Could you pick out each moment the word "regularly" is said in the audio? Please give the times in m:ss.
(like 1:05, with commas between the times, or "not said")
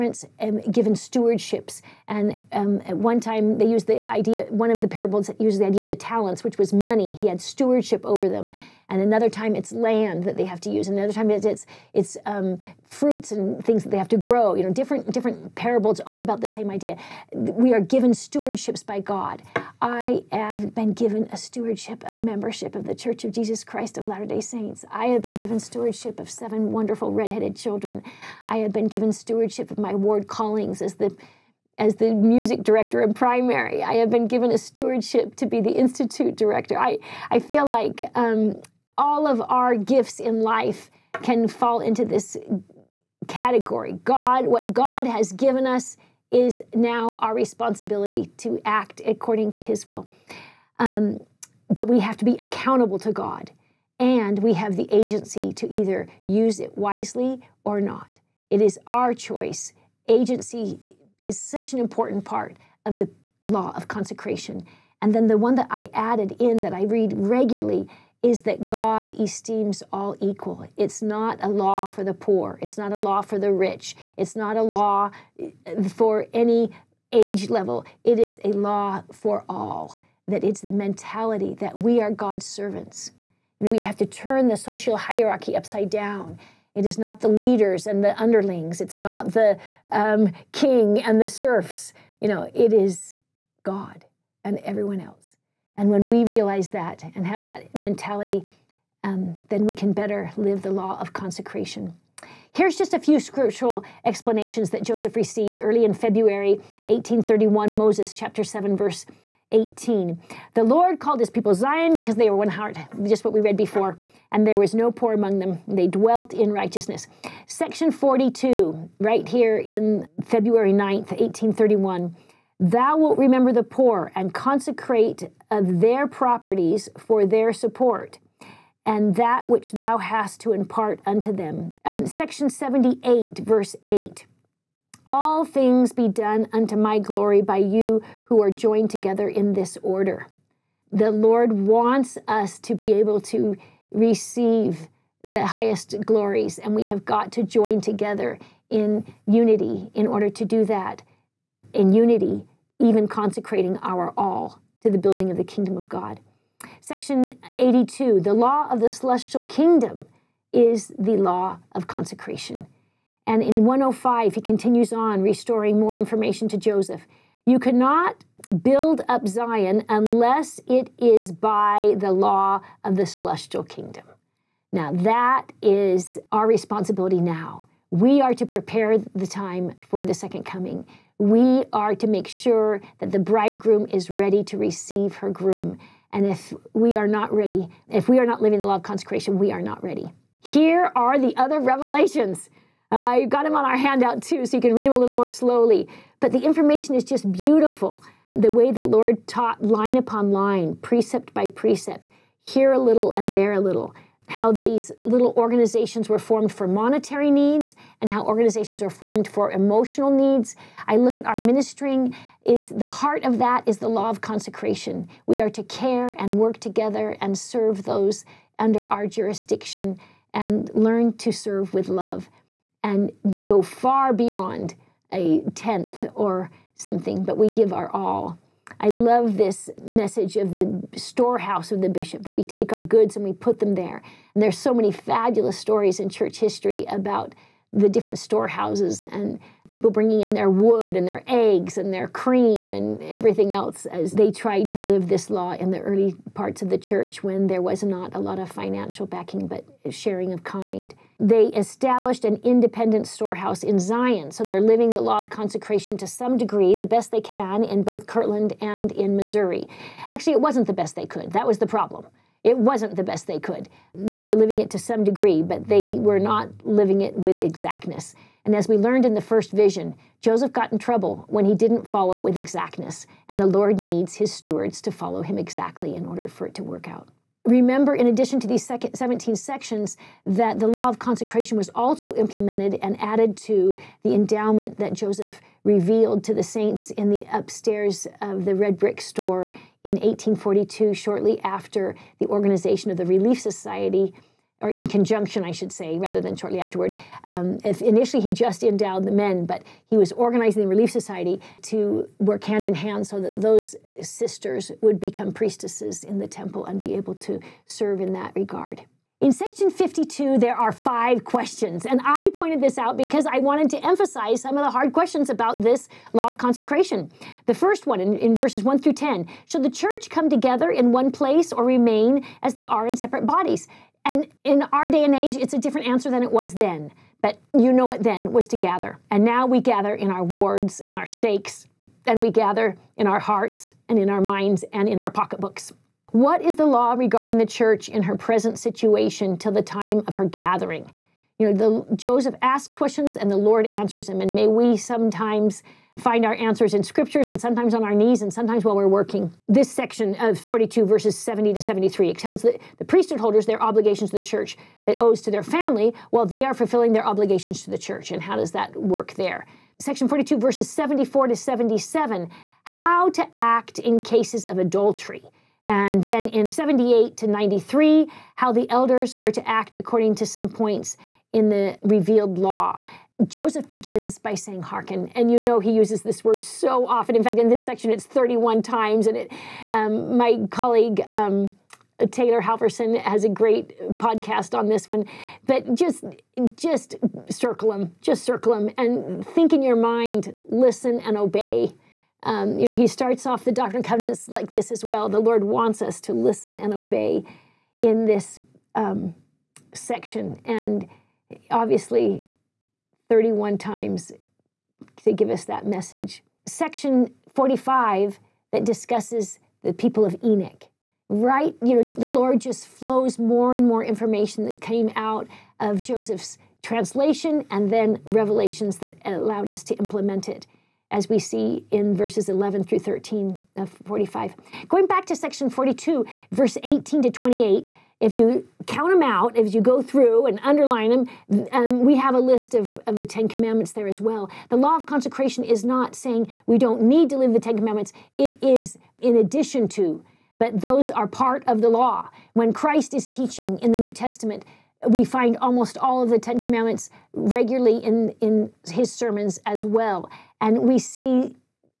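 1:07, 7:27.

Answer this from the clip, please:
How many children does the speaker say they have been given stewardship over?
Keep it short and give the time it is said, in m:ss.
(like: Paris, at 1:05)
7, at 0:26.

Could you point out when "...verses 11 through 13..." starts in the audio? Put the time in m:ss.
7:01.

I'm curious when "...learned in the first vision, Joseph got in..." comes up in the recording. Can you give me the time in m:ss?
4:28.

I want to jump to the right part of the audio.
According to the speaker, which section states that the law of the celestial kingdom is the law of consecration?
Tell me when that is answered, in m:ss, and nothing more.
2:36.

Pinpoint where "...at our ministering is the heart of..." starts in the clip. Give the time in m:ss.
3:31.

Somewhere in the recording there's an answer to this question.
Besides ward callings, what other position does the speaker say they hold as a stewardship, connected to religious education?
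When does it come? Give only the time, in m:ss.
0:35.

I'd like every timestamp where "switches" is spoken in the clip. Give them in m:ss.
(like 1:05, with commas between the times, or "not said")
not said.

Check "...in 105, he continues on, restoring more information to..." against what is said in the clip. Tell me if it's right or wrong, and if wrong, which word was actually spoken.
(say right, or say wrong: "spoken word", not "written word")
right.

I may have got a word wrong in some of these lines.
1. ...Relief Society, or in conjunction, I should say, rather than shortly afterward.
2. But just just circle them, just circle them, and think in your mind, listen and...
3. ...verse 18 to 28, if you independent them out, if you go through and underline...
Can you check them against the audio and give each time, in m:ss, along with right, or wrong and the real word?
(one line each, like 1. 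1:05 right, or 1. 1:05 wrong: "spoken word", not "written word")
1. 4:53 right
2. 6:25 right
3. 7:06 wrong: "count", not "independent".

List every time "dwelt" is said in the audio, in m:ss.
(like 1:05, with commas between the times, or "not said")
1:55.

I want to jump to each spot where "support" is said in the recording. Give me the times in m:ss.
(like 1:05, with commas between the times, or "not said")
2:07.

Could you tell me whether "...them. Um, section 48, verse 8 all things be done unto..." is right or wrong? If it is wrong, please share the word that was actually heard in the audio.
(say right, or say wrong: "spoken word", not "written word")
wrong: "78", not "48".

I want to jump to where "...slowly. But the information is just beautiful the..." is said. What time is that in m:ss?
3:15.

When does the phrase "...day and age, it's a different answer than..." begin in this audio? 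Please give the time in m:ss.
5:24.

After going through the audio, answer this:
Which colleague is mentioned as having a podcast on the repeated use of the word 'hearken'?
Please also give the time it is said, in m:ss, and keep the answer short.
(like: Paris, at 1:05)
Taylor Halverson, at 6:22.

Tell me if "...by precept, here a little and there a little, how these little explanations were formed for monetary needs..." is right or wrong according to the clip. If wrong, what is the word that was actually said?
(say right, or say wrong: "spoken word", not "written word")
wrong: "organizations", not "explanations".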